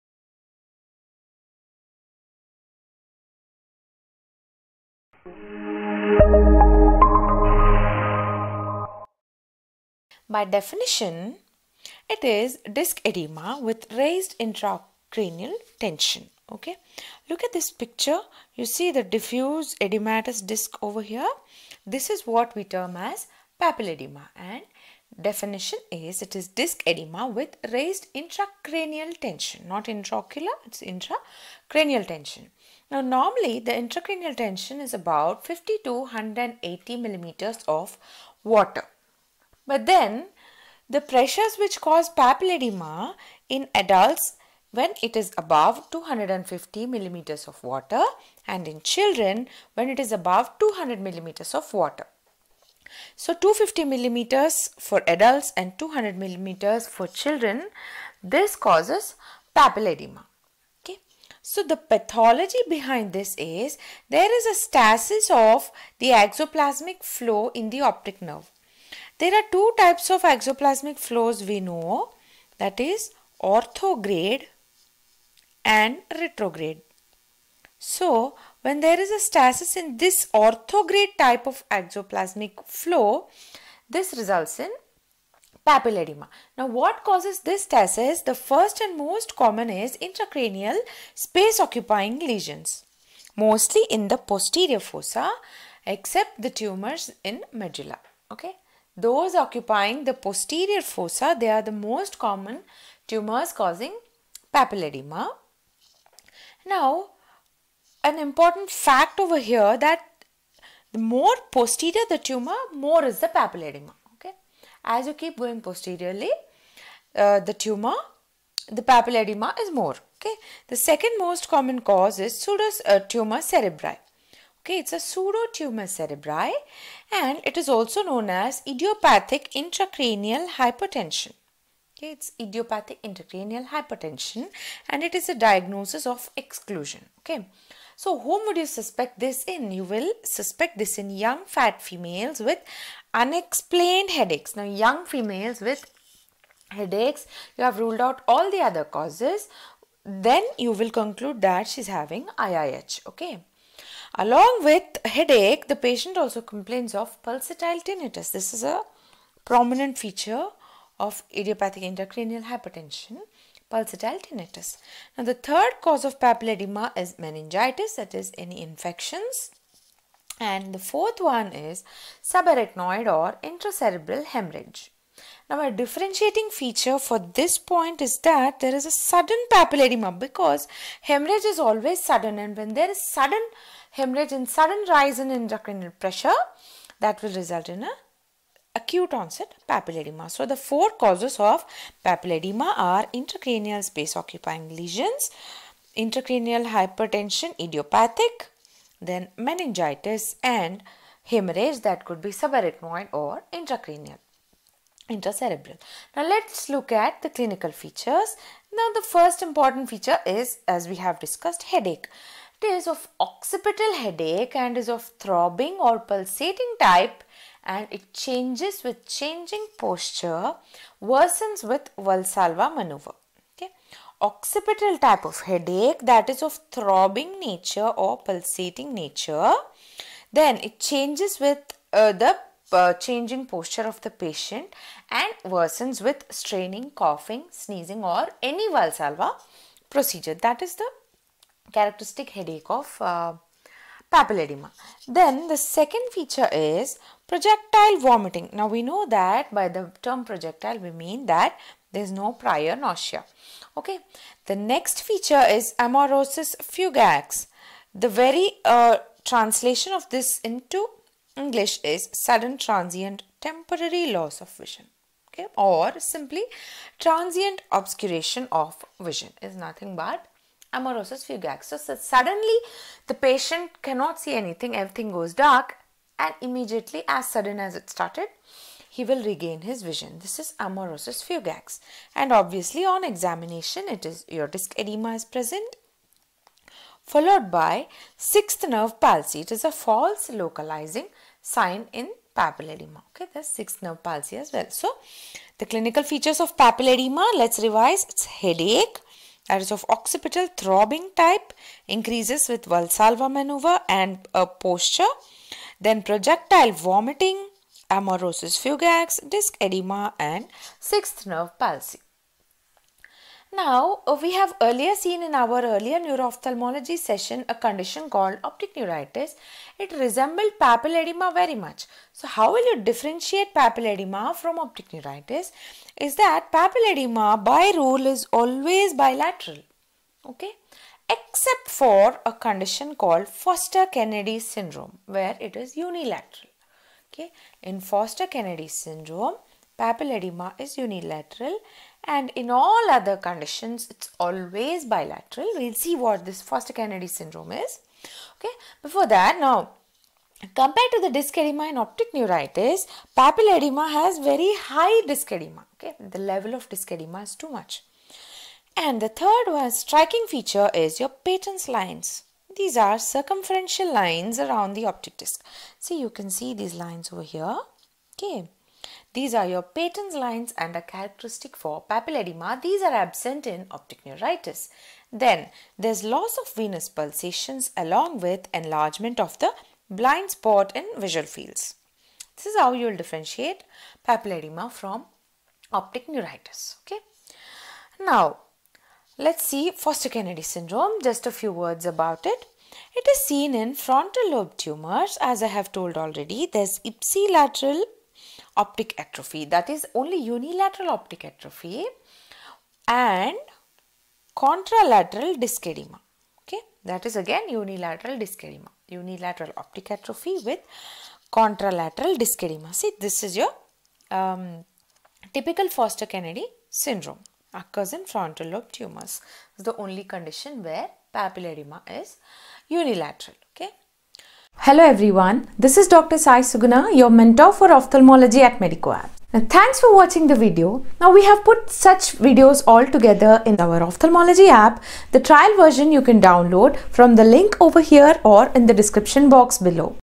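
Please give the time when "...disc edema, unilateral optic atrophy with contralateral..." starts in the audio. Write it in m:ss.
6:48.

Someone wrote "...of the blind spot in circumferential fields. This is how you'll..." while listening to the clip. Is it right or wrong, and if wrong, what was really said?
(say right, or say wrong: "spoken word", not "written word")
wrong: "visual", not "circumferential".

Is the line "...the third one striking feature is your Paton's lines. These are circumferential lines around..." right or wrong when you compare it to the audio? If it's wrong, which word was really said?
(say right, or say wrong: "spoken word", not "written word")
right.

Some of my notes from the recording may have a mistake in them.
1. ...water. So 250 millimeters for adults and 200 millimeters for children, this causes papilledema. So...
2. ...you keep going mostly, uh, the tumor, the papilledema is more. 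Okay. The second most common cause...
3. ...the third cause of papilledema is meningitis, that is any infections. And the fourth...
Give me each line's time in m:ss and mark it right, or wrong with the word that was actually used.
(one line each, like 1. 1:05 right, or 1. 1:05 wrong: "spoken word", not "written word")
1. 0:51 right
2. 1:55 wrong: "posteriorly", not "mostly"
3. 2:45 right.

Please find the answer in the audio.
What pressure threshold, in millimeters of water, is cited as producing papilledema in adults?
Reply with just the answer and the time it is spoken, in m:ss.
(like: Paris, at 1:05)
250, at 0:45.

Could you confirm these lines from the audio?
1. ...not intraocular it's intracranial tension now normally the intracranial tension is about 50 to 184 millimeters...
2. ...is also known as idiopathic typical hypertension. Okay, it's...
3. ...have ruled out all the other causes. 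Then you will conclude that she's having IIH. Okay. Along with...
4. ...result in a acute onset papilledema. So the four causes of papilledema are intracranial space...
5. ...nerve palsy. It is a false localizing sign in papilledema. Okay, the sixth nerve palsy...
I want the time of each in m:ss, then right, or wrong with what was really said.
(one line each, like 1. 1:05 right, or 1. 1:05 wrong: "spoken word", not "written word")
1. 0:29 wrong: "180", not "184"
2. 2:07 wrong: "intracranial", not "typical"
3. 2:27 right
4. 3:07 right
5. 4:48 right.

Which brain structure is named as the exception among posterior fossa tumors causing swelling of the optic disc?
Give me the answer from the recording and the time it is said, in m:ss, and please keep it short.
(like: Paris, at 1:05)
medulla, at 1:37.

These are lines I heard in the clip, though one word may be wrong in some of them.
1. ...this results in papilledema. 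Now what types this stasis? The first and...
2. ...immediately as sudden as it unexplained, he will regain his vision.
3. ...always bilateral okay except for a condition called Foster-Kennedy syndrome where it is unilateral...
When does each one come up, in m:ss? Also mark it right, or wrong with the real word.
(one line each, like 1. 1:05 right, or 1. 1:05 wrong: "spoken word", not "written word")
1. 1:23 wrong: "causes", not "types"
2. 4:36 wrong: "started", not "unexplained"
3. 5:28 right.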